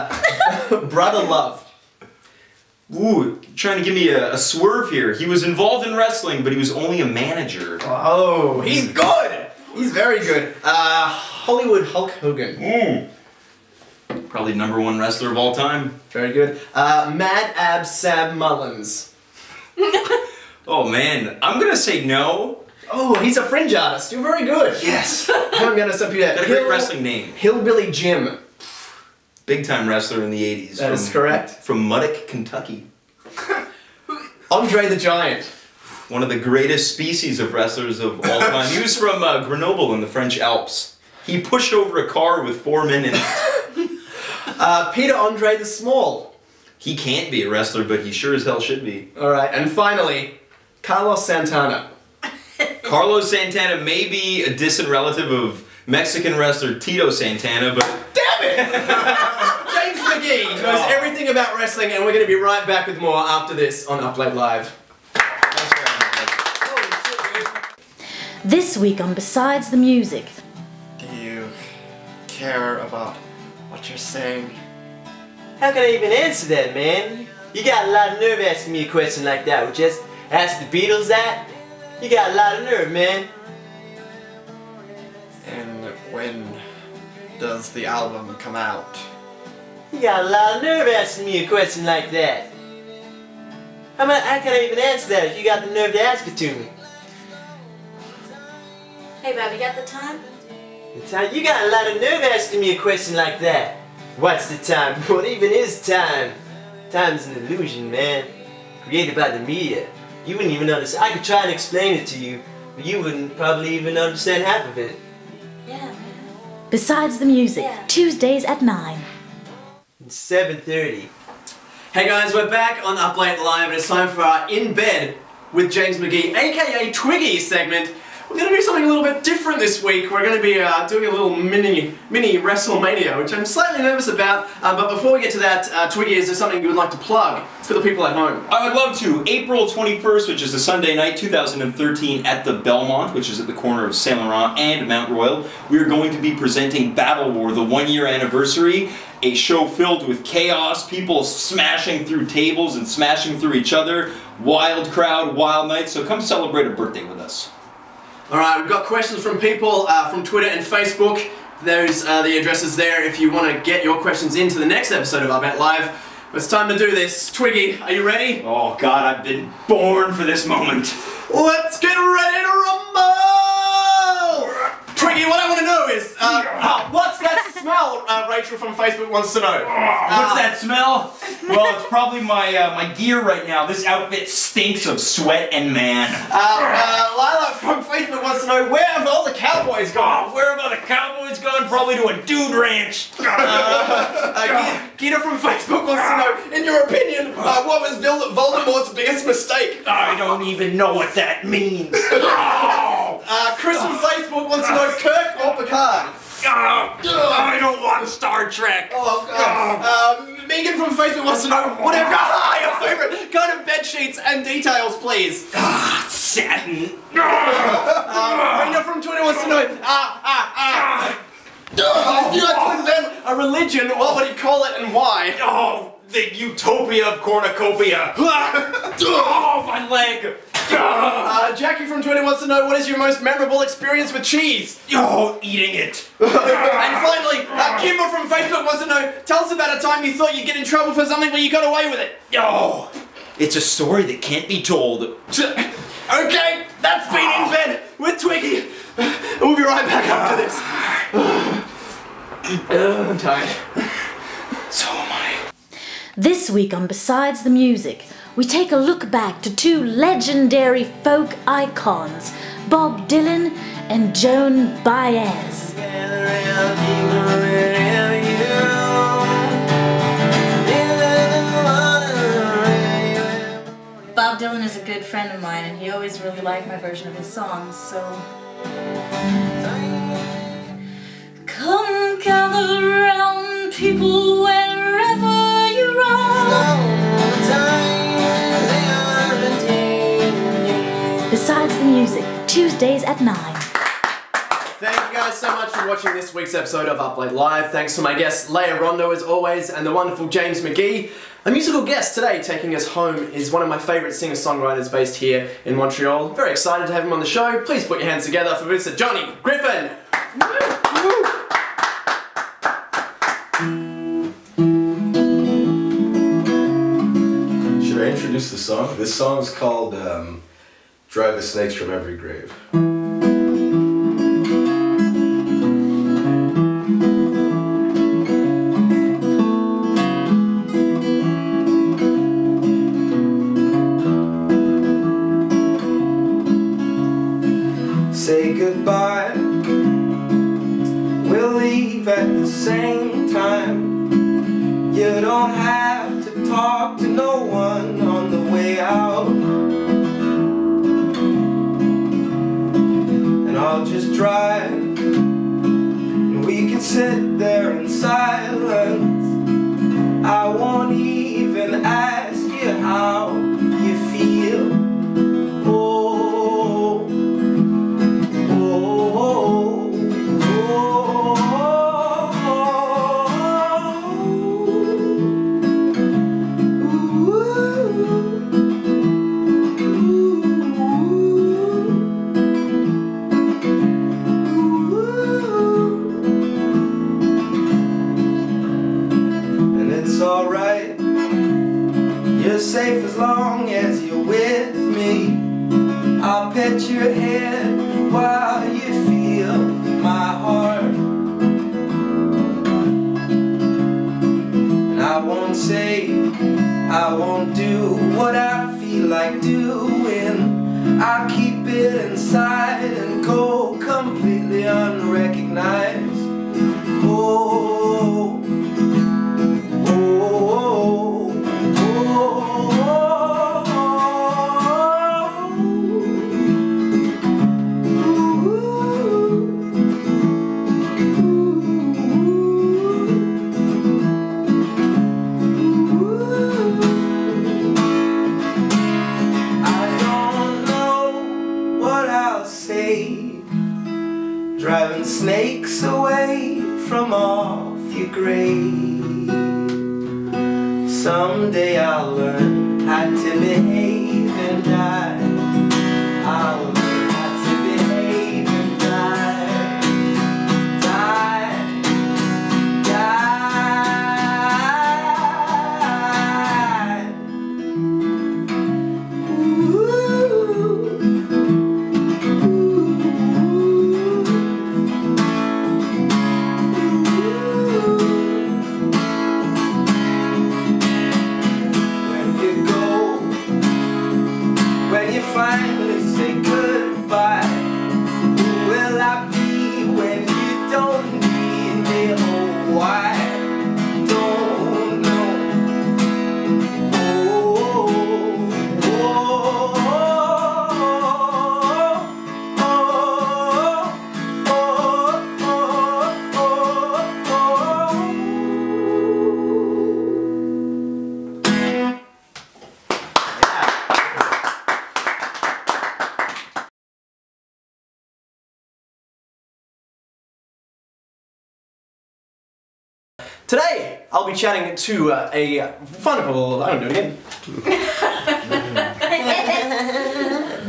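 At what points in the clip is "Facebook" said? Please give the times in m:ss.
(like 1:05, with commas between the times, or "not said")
2:40, 2:58, 3:07, 3:15, 3:23, 3:30, 3:58.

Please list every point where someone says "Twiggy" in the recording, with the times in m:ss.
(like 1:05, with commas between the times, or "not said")
2:06, 2:15, 2:47, 2:55, 4:08.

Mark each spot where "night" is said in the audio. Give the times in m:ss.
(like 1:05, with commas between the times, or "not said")
2:20, 2:35.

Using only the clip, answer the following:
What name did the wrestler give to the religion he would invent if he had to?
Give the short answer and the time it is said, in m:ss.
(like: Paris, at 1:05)
The utopia of cornucopia, at 3:46.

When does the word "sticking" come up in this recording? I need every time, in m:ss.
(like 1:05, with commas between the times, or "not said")
not said.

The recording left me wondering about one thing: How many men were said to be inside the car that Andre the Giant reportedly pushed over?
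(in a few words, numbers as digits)
4.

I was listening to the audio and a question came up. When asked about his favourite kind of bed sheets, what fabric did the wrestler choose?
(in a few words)
Satin.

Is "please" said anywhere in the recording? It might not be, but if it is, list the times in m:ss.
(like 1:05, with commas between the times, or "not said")
3:34, 5:07.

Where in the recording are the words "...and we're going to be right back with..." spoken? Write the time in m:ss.
1:01.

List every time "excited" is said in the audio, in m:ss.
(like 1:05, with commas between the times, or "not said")
5:06.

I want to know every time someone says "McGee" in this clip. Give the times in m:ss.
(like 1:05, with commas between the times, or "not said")
0:59, 2:05, 5:00.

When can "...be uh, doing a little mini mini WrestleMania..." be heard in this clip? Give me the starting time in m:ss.
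2:10.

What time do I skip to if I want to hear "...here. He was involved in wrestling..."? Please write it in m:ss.
0:04.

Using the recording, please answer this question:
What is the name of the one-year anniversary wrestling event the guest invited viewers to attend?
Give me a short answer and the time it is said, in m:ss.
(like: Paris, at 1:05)
Battle War, at 2:26.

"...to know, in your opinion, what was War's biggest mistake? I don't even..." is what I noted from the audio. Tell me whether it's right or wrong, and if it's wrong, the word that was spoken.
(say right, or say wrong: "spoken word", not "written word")
wrong: "Voldemort", not "War".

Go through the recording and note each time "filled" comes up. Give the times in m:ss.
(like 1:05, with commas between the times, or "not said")
2:29.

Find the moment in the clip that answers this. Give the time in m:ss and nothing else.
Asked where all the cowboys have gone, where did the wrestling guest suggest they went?
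3:12.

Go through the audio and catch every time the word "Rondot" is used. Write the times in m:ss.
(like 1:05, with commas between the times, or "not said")
4:58.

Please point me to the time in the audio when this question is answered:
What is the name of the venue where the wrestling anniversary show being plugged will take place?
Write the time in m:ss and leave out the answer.
2:22.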